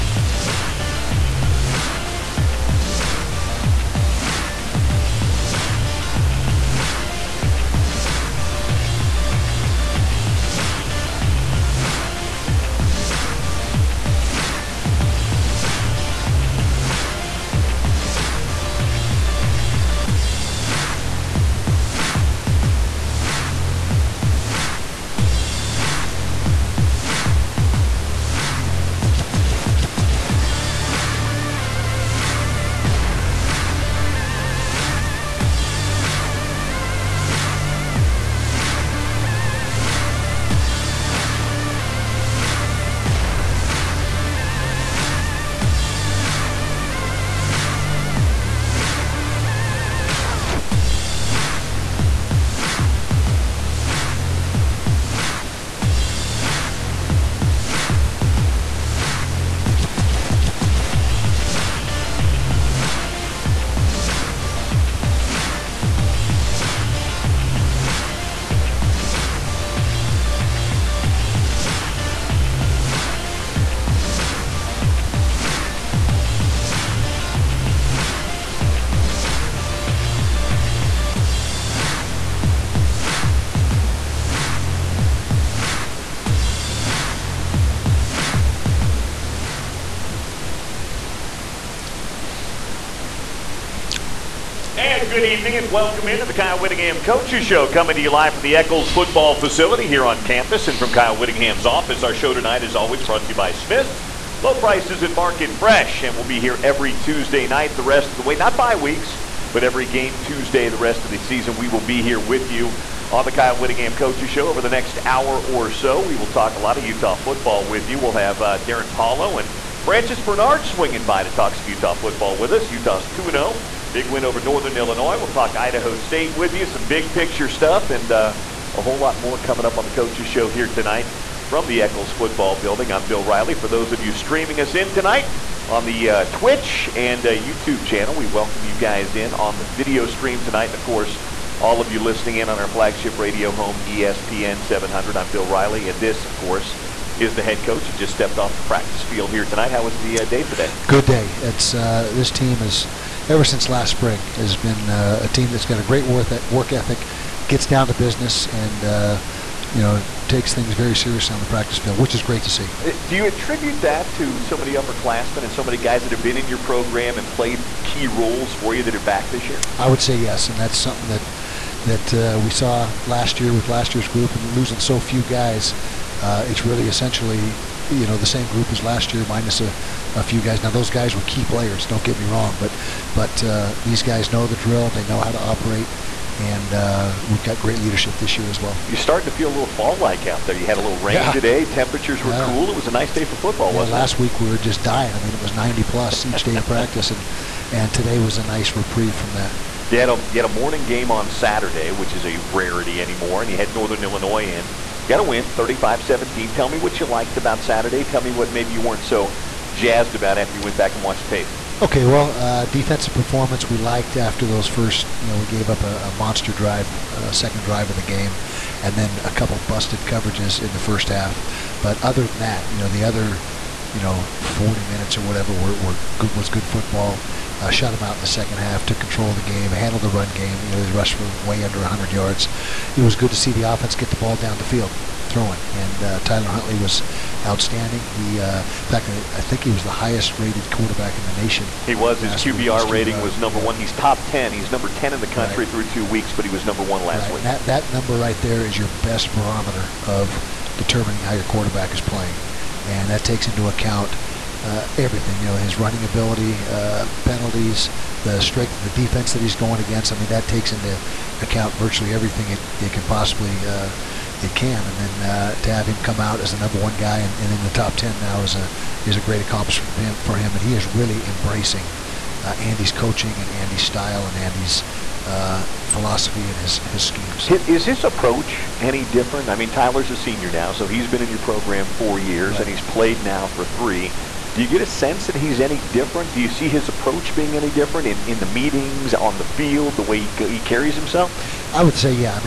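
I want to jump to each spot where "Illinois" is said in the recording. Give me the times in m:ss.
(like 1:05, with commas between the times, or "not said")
2:04, 3:24.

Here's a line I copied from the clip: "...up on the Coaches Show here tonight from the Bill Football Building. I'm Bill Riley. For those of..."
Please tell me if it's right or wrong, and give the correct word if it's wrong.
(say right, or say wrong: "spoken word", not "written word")
wrong: "Eccles", not "Bill".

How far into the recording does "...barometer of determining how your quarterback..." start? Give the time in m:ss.
4:09.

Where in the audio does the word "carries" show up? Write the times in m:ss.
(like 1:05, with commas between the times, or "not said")
4:50.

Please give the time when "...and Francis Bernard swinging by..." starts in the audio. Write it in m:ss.
1:59.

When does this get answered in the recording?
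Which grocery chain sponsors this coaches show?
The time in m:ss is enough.
1:43.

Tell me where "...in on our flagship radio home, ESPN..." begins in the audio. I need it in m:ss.
2:22.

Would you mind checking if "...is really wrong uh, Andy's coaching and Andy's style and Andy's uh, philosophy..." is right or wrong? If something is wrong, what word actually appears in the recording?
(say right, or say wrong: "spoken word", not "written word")
wrong: "embracing", not "wrong".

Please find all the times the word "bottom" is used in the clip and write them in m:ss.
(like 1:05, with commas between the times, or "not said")
not said.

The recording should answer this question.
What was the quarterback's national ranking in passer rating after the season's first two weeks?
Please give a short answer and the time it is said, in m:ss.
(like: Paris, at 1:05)
10, at 4:04.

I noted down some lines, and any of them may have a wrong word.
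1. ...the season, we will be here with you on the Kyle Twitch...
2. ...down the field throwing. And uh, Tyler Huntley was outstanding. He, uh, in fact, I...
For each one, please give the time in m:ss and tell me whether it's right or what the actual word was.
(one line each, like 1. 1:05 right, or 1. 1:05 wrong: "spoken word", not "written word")
1. 1:51 wrong: "Whittingham", not "Twitch"
2. 3:54 right.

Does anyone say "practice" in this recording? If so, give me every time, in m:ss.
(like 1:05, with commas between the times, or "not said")
2:28, 2:41, 3:16.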